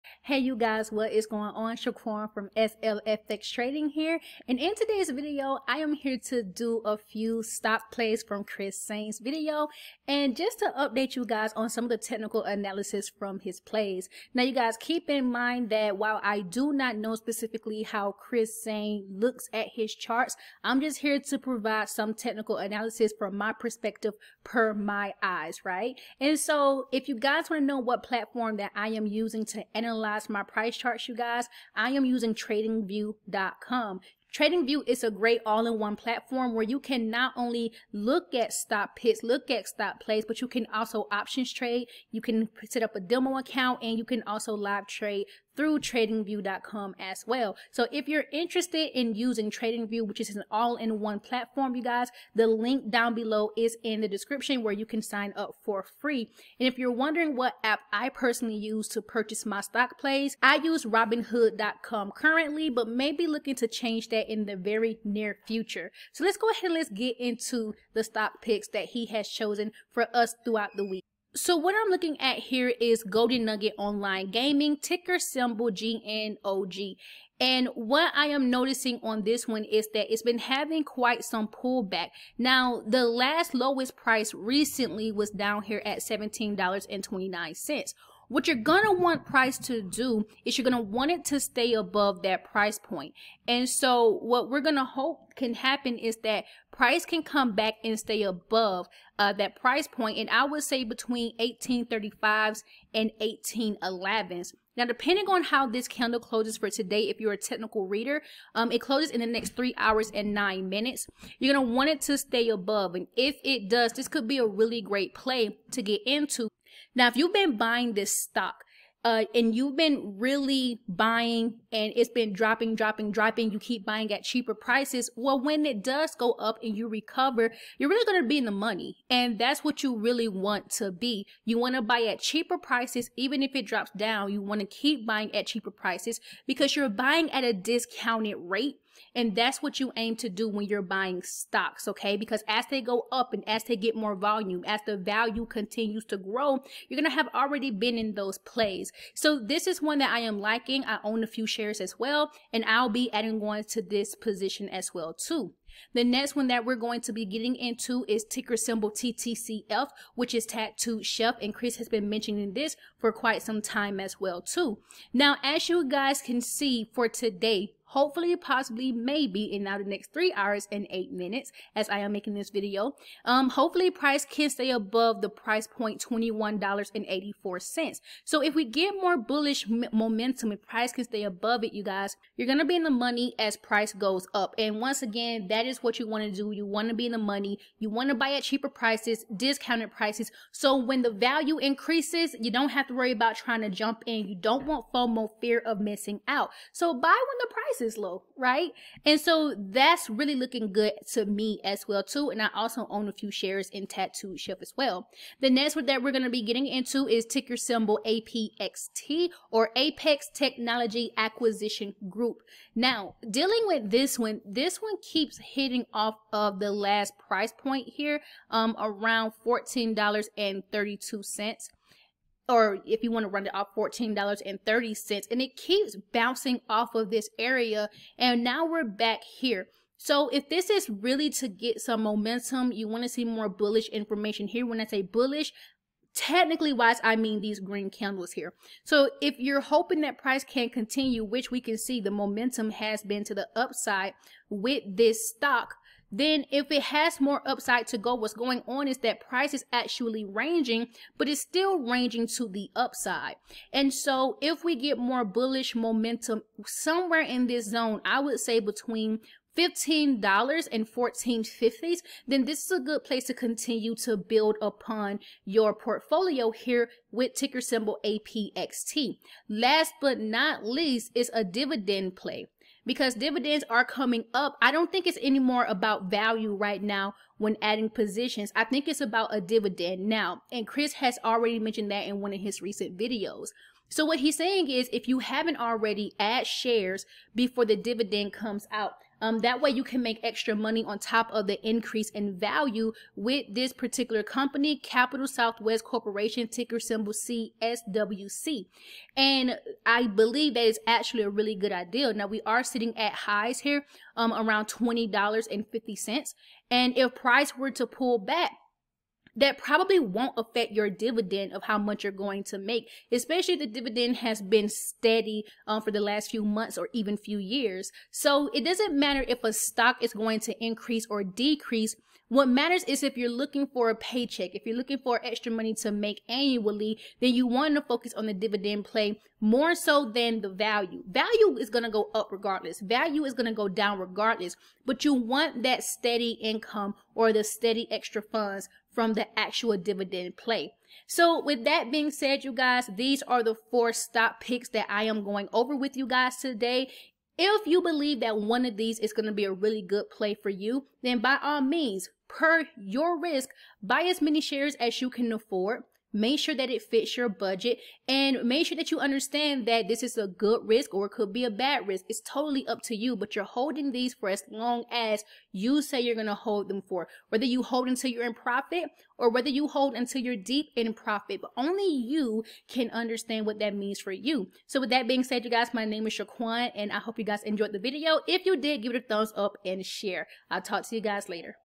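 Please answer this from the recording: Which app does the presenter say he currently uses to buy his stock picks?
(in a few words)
robinhood.com.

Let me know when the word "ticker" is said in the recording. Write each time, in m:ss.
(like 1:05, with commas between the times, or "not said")
1:14, 2:38, 3:27, 4:27, 4:56.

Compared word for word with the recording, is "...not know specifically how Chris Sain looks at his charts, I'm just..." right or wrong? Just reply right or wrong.
right.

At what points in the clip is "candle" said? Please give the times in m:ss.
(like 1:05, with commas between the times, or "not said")
1:45, 3:57.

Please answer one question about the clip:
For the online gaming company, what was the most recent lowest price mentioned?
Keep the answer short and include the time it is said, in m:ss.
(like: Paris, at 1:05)
$17.29, at 1:25.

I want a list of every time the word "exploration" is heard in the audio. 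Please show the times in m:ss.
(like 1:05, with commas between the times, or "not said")
not said.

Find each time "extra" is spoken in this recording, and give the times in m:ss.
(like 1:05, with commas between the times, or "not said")
4:50, 5:25, 5:37.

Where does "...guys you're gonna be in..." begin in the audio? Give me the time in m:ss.
3:01.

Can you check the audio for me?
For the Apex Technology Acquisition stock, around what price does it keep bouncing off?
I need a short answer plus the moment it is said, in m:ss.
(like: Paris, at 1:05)
$14.32, at 3:39.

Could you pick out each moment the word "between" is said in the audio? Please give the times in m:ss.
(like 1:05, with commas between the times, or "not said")
1:40, 4:18.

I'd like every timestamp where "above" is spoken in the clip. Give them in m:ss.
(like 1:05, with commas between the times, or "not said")
1:31, 1:38, 1:52, 2:54, 3:01.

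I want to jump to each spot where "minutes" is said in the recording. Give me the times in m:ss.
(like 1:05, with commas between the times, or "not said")
1:50, 2:51.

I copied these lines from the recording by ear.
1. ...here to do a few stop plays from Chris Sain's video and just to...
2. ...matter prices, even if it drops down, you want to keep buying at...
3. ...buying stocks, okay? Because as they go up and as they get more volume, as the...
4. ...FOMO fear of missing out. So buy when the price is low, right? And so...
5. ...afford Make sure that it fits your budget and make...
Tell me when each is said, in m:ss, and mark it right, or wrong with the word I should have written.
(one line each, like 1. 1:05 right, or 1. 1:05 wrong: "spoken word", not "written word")
1. 0:05 right
2. 2:12 wrong: "cheaper", not "matter"
3. 2:20 right
4. 3:14 right
5. 5:55 right.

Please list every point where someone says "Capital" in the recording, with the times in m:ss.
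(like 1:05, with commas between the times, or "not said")
4:54.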